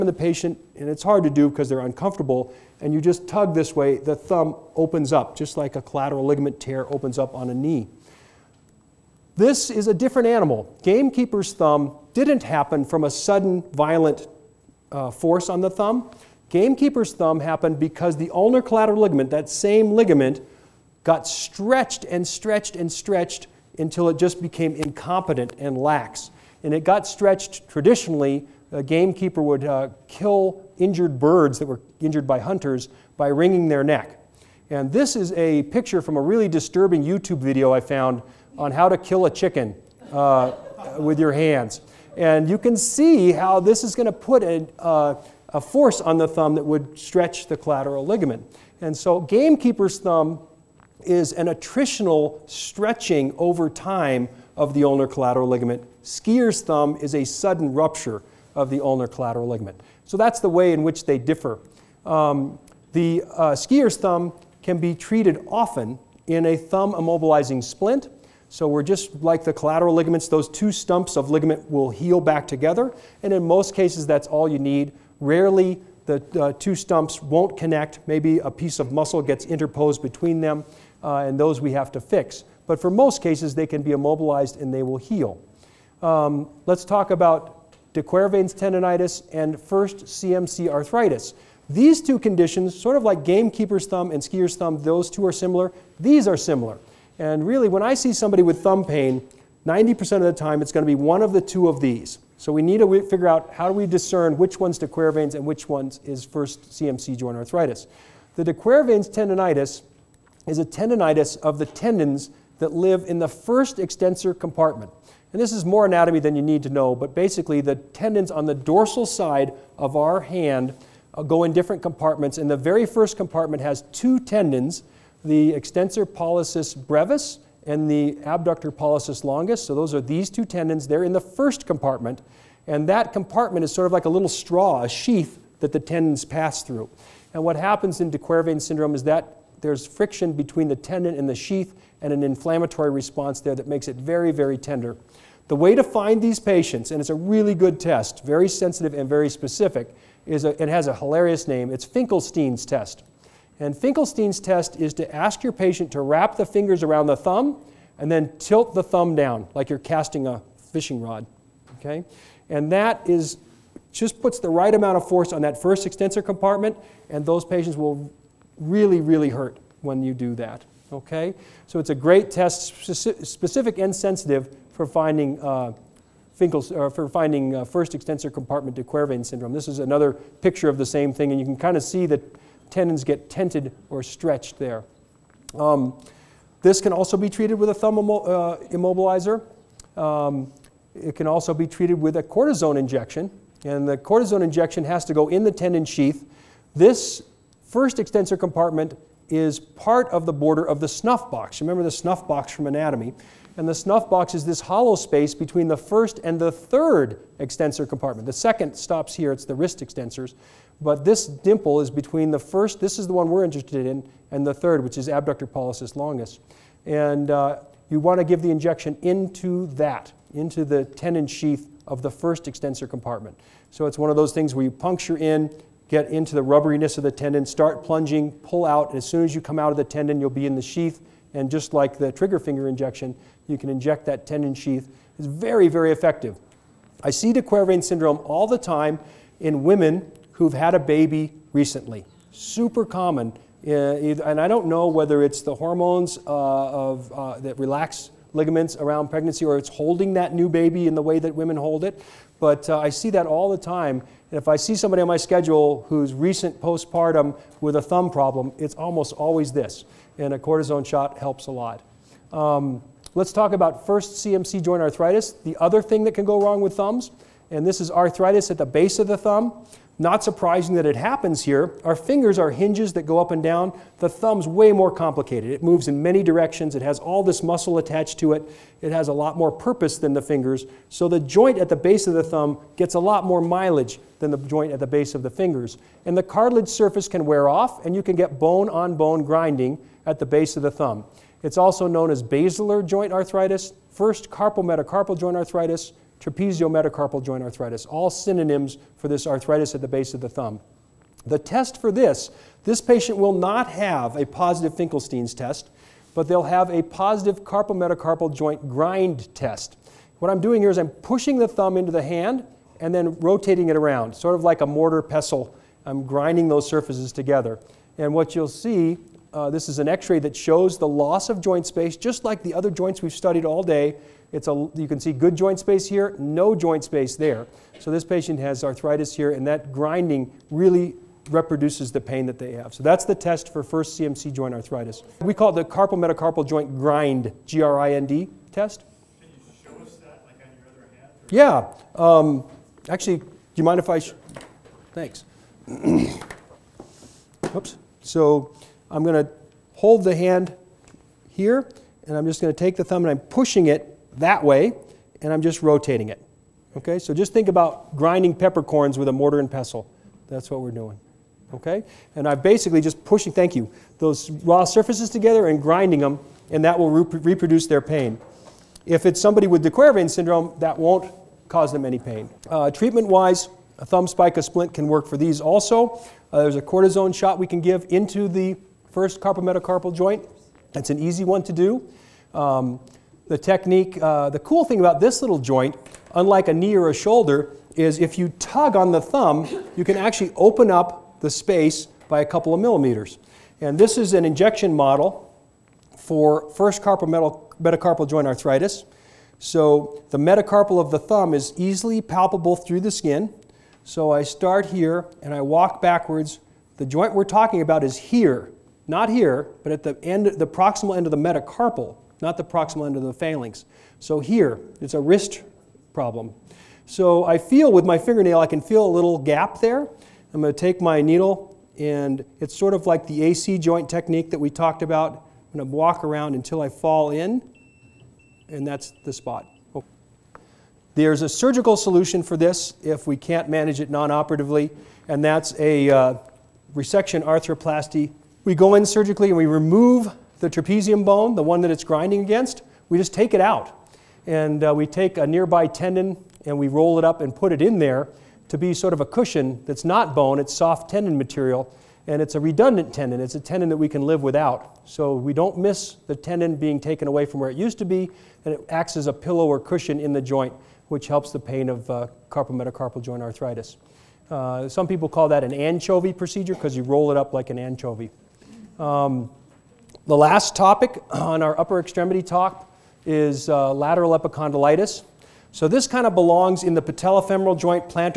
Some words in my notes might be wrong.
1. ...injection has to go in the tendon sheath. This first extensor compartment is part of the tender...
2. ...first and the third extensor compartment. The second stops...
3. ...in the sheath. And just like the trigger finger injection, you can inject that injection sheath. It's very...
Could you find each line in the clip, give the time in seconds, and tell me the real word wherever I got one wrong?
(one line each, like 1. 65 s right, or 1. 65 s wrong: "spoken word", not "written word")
1. 194 s wrong: "border", not "tender"
2. 205 s right
3. 230 s wrong: "tendon", not "injection".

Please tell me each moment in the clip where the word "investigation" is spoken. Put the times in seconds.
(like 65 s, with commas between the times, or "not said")
not said.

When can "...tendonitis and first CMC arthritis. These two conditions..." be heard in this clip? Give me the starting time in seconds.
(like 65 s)
88 s.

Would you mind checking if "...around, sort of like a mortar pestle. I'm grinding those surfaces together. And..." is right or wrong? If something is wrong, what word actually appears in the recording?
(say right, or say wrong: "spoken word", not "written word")
right.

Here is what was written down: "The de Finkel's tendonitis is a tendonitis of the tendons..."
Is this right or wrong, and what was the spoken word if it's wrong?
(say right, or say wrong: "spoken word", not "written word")
wrong: "Quervain", not "Finkel".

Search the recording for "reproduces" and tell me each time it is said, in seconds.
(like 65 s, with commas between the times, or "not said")
331 s, 367 s.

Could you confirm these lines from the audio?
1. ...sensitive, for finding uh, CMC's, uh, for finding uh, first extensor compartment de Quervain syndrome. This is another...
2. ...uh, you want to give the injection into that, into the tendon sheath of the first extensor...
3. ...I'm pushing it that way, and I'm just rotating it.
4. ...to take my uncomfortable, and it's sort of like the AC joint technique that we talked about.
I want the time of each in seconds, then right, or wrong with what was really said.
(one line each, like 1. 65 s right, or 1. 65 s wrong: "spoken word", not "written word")
1. 173 s wrong: "Finkel", not "CMC"
2. 217 s right
3. 353 s right
4. 420 s wrong: "needle", not "uncomfortable".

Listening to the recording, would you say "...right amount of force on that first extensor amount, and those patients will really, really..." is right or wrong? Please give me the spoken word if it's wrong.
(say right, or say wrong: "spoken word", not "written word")
wrong: "compartment", not "amount".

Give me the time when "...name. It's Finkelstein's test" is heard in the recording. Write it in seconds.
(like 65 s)
151 s.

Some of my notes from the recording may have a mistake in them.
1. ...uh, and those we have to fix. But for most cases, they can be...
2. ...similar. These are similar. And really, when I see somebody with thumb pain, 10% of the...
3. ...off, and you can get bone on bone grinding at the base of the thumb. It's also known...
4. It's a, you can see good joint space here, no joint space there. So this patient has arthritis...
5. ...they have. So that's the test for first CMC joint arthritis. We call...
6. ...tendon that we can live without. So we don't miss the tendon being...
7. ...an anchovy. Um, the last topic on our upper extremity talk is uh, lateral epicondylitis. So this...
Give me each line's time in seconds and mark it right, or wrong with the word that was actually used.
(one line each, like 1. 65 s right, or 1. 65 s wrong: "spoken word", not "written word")
1. 81 s right
2. 95 s wrong: "90", not "10"
3. 287 s right
4. 324 s right
5. 332 s right
6. 453 s right
7. 467 s right.